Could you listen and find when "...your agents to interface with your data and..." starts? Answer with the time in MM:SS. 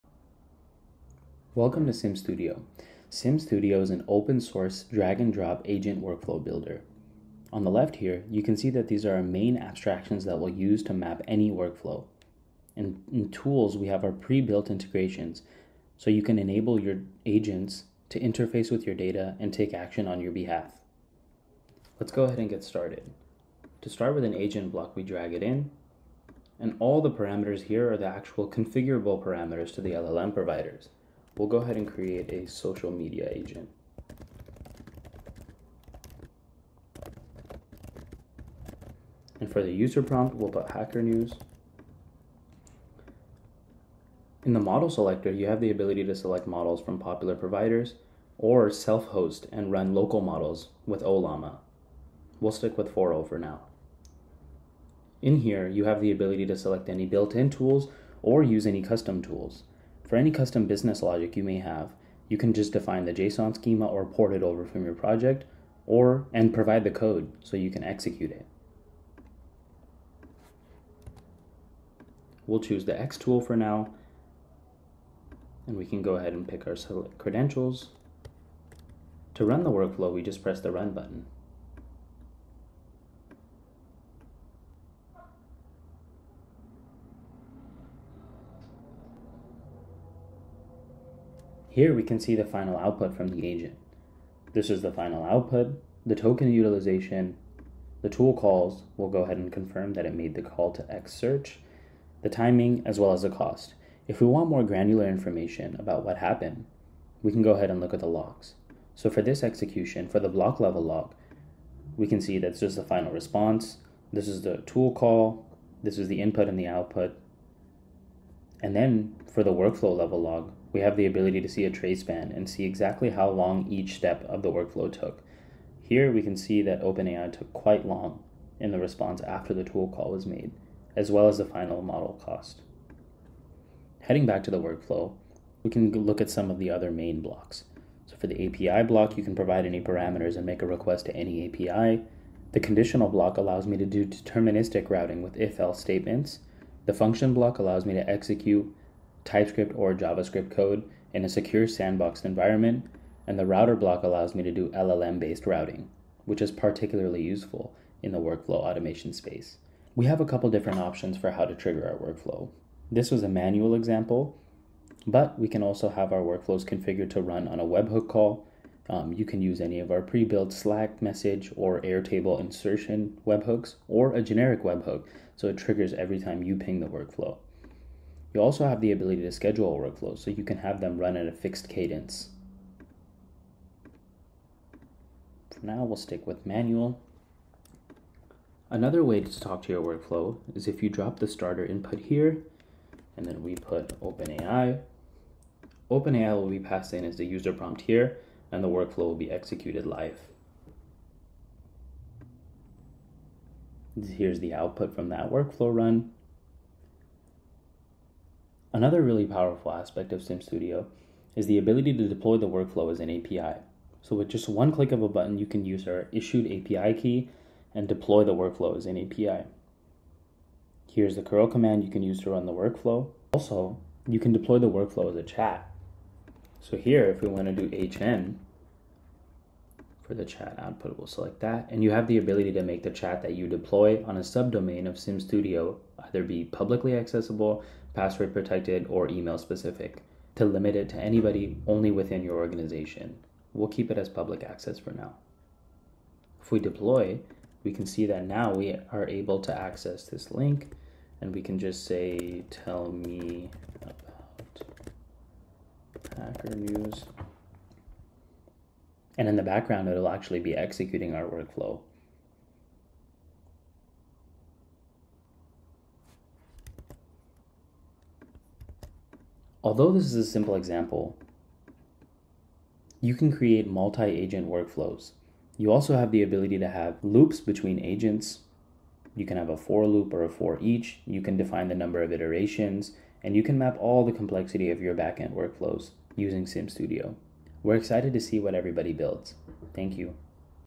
00:16.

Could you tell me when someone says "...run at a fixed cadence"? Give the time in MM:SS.
03:00.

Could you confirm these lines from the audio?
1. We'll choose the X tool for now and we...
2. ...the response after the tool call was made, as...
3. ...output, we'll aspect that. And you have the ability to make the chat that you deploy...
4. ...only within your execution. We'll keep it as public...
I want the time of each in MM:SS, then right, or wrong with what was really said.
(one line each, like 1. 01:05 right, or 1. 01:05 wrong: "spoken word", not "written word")
1. 01:12 right
2. 02:08 right
3. 03:50 wrong: "select", not "aspect"
4. 04:01 wrong: "organization", not "execution".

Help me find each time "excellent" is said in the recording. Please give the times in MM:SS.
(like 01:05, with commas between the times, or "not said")
not said.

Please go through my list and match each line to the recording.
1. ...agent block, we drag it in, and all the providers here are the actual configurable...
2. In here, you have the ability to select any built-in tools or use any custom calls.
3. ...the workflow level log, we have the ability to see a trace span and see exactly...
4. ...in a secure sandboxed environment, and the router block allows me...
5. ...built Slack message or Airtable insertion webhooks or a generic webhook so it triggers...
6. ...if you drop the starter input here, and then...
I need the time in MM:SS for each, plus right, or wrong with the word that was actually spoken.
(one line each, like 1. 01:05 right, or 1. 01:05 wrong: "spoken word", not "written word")
1. 00:24 wrong: "parameters", not "providers"
2. 00:55 wrong: "tools", not "calls"
3. 01:59 right
4. 02:31 right
5. 02:50 right
6. 03:10 right.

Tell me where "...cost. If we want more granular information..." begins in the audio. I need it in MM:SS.
01:43.